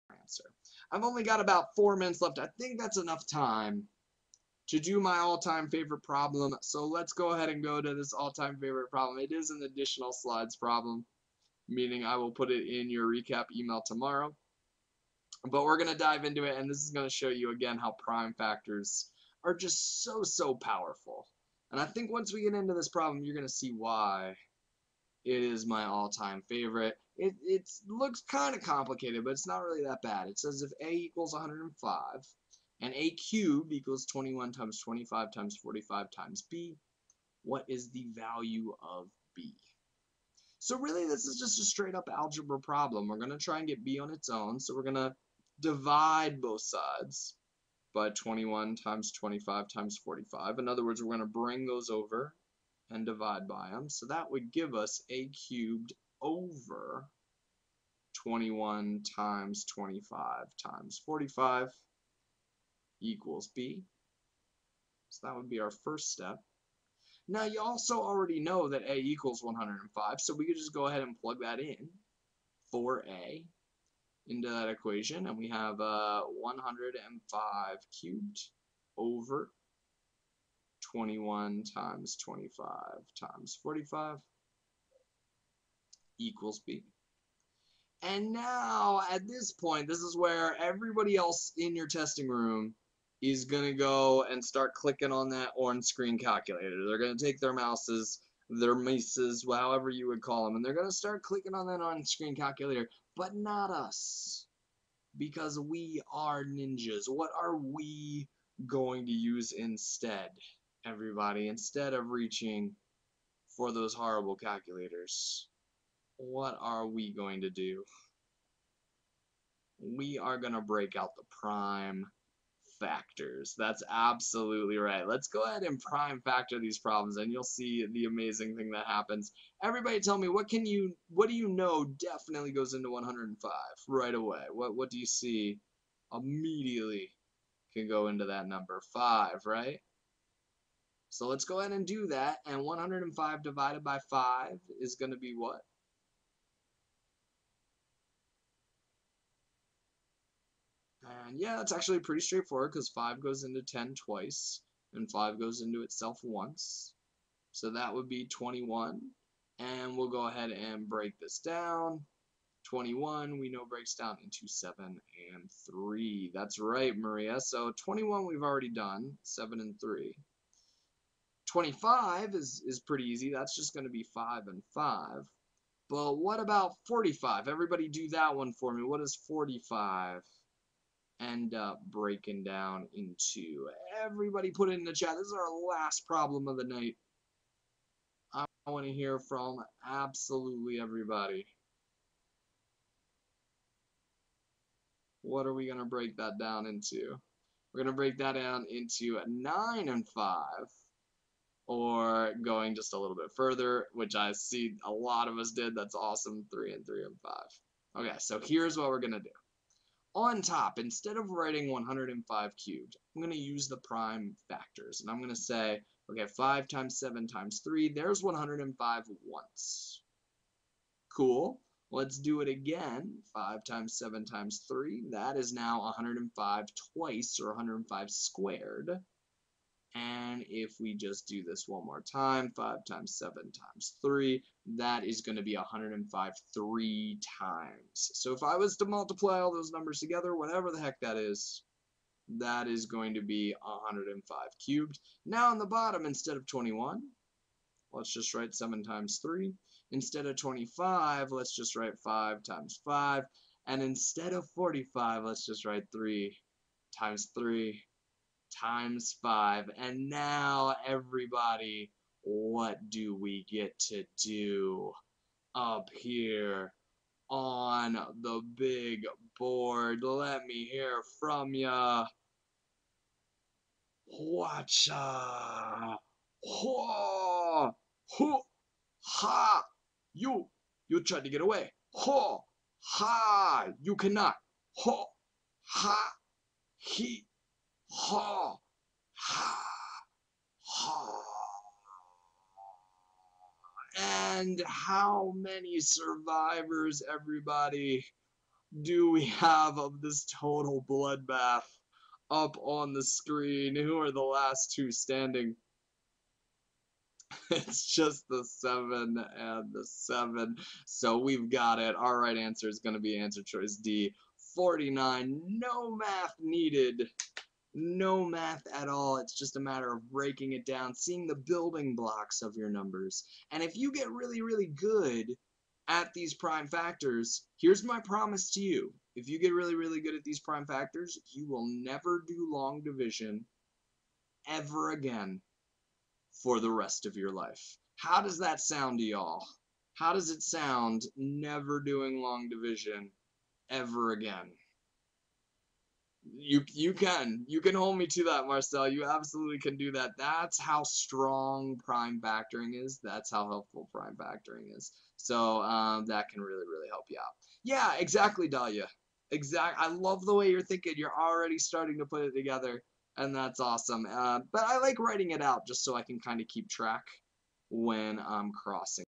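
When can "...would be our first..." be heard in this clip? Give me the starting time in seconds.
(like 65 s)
65 s.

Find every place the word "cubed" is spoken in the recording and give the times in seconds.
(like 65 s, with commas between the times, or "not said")
33 s, 55 s, 77 s, 212 s, 244 s.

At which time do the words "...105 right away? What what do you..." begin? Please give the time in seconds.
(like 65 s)
132 s.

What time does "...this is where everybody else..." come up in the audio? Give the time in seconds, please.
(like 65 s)
89 s.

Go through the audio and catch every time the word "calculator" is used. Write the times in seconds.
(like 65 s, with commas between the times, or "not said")
96 s, 102 s, 114 s.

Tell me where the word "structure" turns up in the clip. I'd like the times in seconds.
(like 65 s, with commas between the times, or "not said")
not said.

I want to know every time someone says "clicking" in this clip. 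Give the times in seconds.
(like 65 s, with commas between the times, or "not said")
94 s, 101 s.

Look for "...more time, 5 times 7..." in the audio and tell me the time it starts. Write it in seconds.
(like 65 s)
231 s.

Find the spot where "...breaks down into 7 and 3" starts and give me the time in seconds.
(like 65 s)
163 s.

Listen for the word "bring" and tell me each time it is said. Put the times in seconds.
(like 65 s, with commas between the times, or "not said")
51 s.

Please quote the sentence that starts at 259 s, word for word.
And now, everybody, what do we get to do up here on the big board?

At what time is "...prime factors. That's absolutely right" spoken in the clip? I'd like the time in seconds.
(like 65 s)
121 s.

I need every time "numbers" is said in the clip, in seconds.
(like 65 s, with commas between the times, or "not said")
138 s, 239 s, 322 s.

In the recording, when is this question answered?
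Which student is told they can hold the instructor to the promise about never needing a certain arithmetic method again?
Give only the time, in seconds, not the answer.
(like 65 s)
348 s.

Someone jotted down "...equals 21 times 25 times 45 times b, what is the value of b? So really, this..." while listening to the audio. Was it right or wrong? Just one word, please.
right.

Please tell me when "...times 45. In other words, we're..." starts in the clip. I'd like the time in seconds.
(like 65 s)
49 s.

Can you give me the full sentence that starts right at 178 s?
What does 45 end up breaking down into?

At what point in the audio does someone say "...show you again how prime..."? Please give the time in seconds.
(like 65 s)
17 s.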